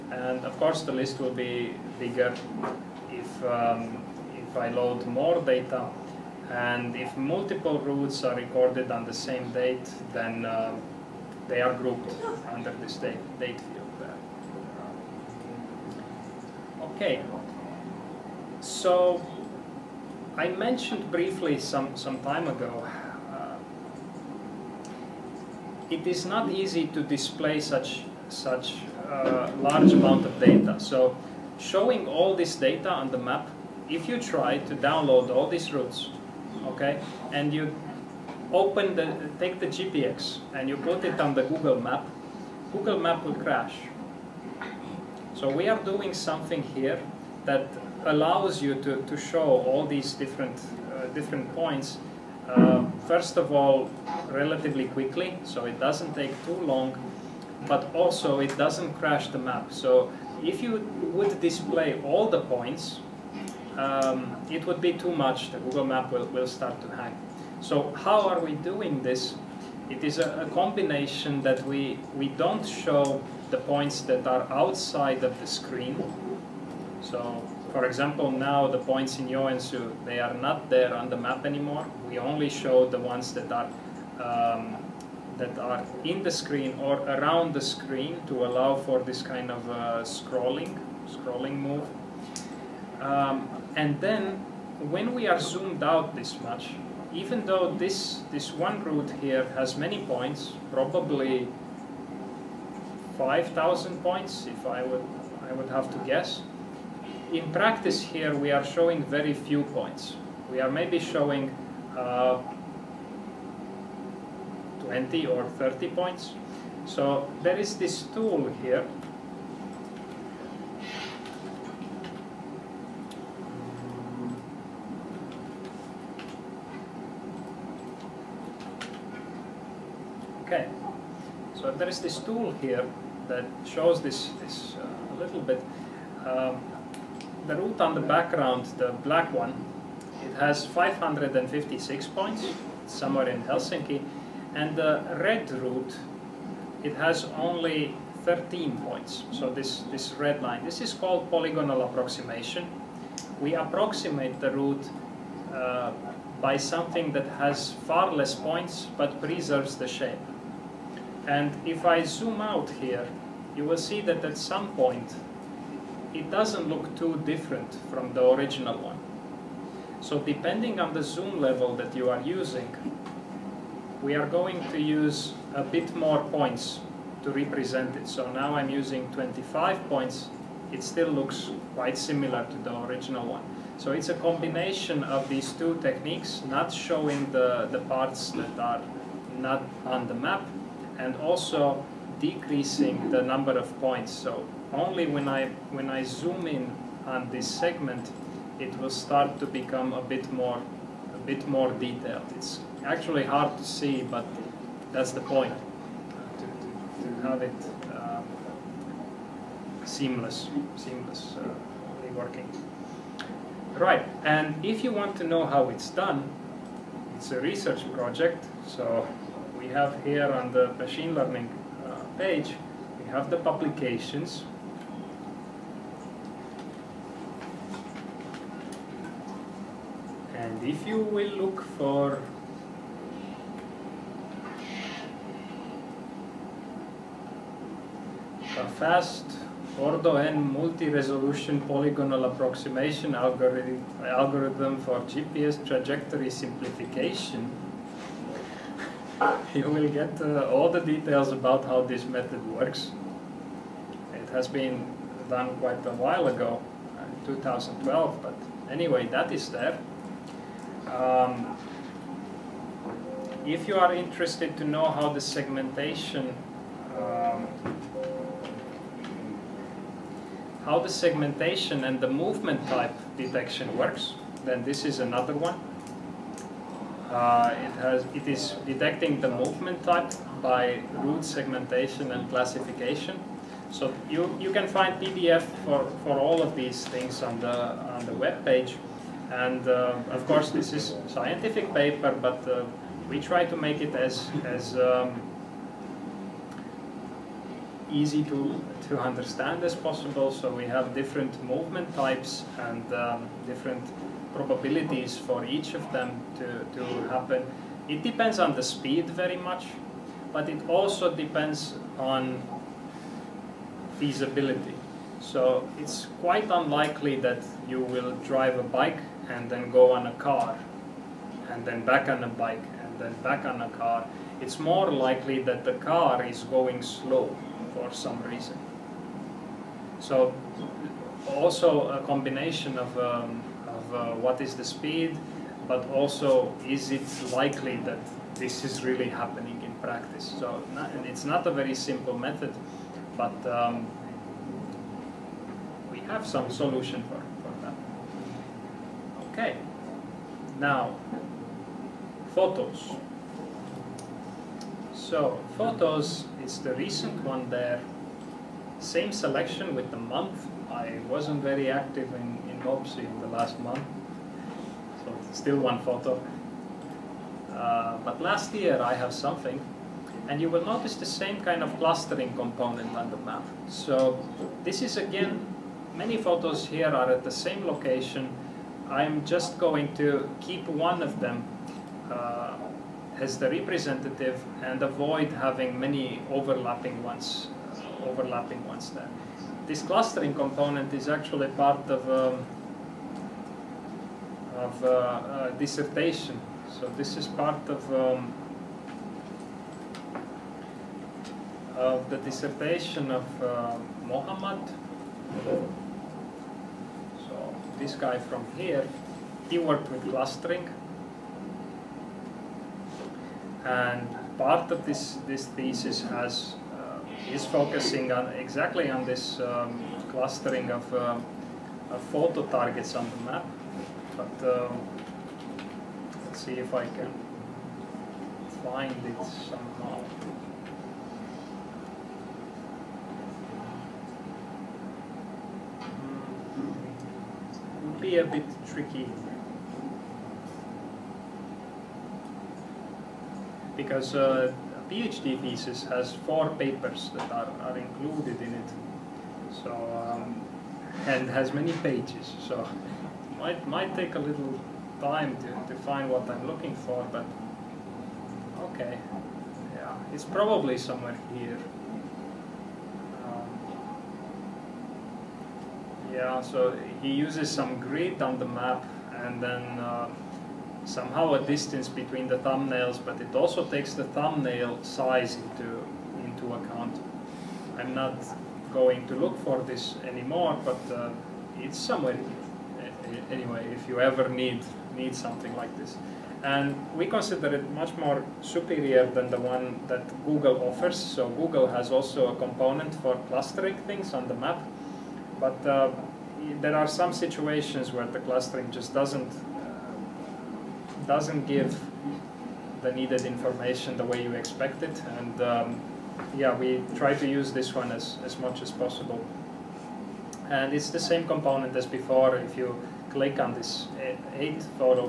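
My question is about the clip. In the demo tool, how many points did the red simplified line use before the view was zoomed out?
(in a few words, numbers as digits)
13.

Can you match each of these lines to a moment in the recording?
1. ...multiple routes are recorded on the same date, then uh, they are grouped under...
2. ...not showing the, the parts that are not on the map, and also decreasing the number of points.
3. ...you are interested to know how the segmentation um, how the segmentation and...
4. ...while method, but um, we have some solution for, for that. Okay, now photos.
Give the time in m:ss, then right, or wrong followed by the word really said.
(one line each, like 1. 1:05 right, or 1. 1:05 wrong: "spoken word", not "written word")
1. 0:07 right
2. 3:06 right
3. 4:23 right
4. 5:41 wrong: "simple", not "while".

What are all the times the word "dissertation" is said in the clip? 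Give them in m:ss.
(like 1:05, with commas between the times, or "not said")
6:35, 6:42.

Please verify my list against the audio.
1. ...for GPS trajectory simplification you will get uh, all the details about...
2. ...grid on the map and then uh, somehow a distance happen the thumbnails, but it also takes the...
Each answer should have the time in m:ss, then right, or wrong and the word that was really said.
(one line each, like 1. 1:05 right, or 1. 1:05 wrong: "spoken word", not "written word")
1. 4:04 right
2. 7:47 wrong: "between", not "happen".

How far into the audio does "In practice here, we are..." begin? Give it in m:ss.
1:47.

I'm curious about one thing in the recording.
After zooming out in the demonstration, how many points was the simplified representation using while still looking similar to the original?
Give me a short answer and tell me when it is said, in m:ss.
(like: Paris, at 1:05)
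25, at 2:59.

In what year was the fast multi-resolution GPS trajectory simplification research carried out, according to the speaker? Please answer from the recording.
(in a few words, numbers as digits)
2012.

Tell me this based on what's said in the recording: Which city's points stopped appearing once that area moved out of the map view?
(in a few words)
Joensuu.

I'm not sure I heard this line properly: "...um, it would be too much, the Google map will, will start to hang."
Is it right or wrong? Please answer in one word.
right.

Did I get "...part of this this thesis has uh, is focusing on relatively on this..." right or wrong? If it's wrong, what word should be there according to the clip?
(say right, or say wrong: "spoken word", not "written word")
wrong: "exactly", not "relatively".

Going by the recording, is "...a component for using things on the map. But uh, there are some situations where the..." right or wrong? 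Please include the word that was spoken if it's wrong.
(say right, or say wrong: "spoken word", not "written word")
wrong: "clustering", not "using".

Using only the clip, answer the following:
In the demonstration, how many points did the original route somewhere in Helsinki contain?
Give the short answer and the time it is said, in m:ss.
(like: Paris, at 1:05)
556, at 2:20.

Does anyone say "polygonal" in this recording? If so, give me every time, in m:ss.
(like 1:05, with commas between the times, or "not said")
2:31, 4:01.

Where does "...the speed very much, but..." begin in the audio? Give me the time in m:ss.
5:08.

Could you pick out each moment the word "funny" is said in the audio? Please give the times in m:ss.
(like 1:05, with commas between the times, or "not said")
not said.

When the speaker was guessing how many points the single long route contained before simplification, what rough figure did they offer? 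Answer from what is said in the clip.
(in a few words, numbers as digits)
5,000.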